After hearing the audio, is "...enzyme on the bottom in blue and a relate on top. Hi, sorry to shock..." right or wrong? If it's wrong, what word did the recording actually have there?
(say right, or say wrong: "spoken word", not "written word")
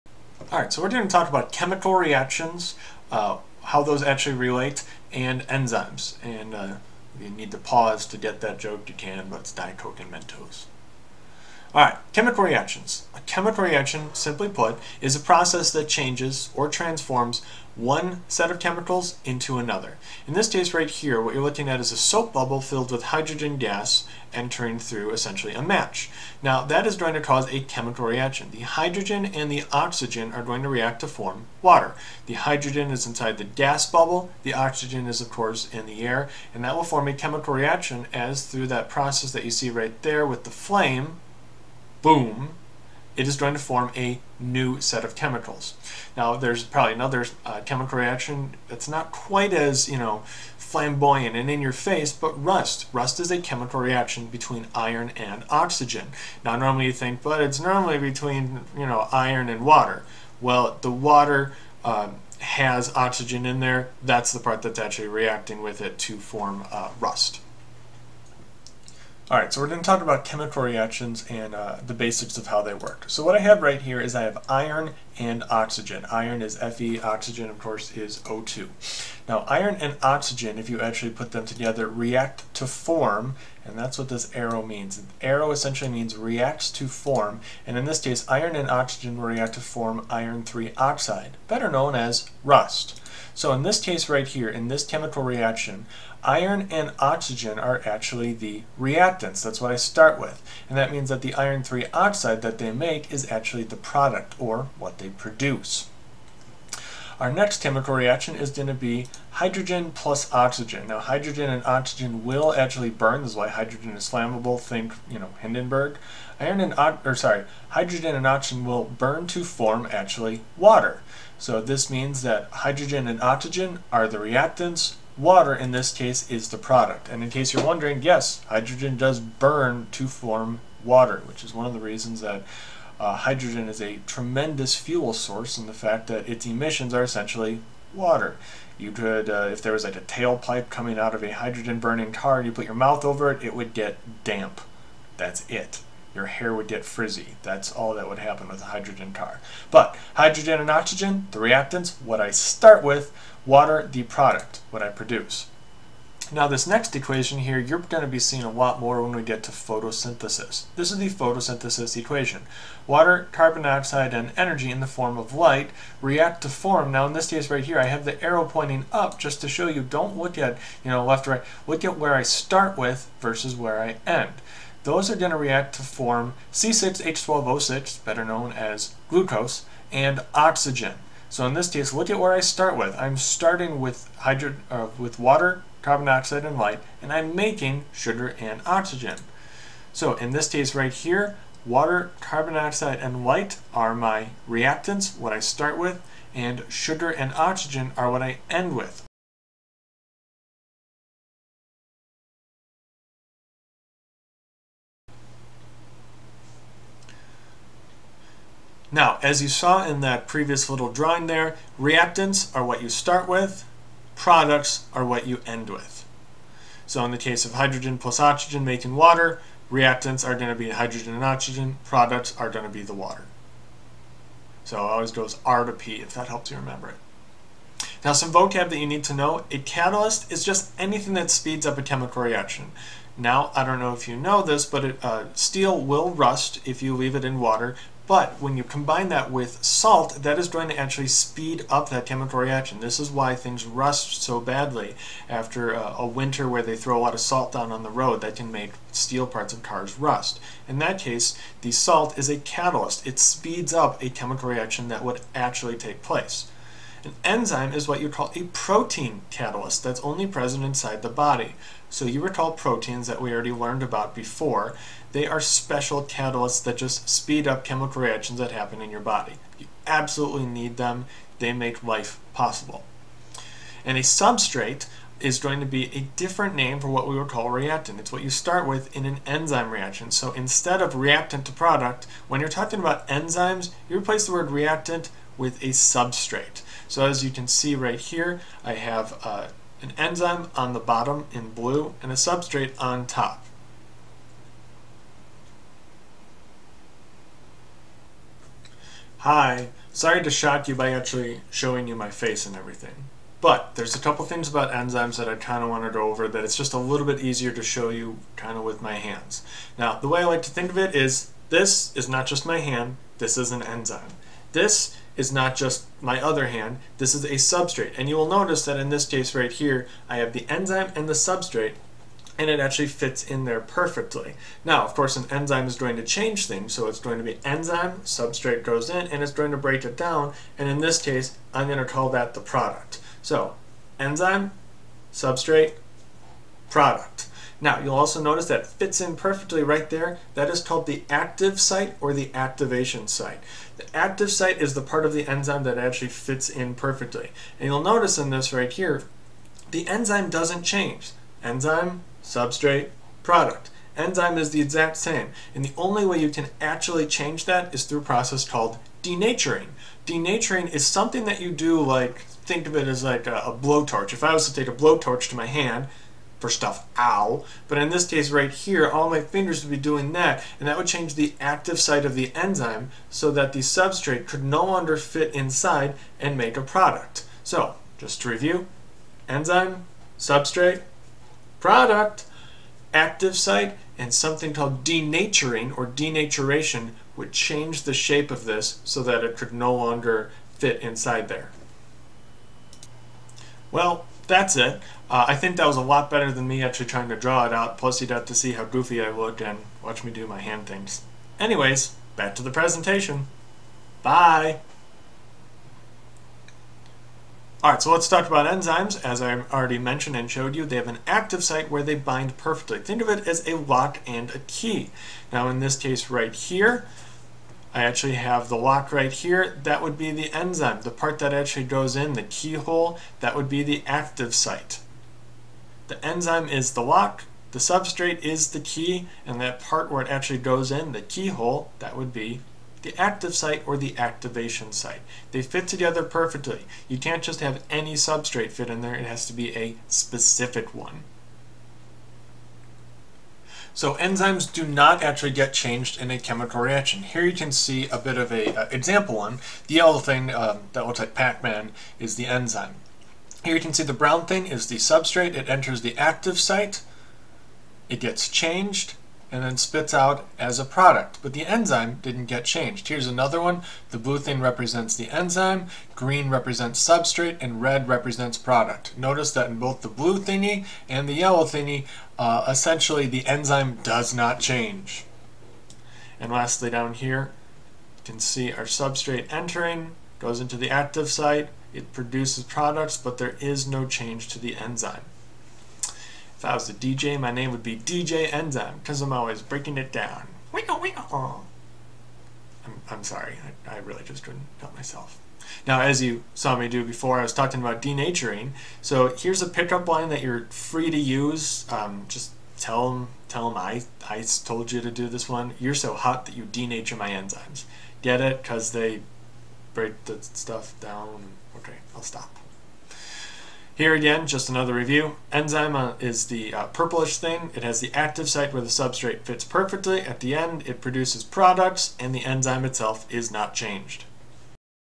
wrong: "substrate", not "relate".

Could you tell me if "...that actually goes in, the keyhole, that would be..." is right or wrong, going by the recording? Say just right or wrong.
right.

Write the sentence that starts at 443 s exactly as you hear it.
So enzymes do not actually get changed in a chemical reaction.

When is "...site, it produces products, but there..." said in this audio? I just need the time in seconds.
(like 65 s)
481 s.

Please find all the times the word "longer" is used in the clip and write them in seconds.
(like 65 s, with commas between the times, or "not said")
374 s, 389 s.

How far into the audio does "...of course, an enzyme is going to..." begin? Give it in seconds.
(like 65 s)
324 s.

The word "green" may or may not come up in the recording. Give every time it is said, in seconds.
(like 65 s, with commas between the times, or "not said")
465 s.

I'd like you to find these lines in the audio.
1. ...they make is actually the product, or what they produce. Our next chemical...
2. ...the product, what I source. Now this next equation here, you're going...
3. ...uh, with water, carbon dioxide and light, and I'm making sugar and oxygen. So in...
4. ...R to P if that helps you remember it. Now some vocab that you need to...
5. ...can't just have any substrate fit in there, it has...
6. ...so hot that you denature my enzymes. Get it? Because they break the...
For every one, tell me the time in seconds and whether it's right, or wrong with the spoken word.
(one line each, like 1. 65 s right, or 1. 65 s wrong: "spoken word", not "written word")
1. 102 s right
2. 153 s wrong: "produce", not "source"
3. 184 s right
4. 225 s right
5. 436 s right
6. 505 s right.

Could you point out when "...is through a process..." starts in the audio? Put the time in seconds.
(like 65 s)
357 s.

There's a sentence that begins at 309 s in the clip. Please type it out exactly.
Now, the way I like to think of it is this is not just my hand, this is an enzyme.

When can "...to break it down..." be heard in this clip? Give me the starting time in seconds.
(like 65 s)
329 s.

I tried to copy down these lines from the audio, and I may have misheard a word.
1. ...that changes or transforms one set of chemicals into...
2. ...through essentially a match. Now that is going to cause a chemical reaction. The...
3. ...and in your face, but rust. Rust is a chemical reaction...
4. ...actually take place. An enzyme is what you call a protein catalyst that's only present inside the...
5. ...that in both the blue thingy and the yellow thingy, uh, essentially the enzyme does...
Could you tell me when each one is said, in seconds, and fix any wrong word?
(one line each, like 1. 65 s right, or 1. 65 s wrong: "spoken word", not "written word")
1. 15 s right
2. 24 s right
3. 51 s right
4. 255 s right
5. 469 s right.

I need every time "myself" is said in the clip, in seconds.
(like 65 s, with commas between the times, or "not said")
494 s.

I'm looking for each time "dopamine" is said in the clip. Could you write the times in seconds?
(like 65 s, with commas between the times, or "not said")
not said.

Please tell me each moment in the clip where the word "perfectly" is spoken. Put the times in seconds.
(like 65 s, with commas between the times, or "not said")
323 s, 339 s, 346 s, 412 s, 436 s, 519 s.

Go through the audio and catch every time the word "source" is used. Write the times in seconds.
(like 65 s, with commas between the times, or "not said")
135 s.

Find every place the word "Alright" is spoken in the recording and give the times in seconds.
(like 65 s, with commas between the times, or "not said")
0 s, 11 s, 69 s, 407 s.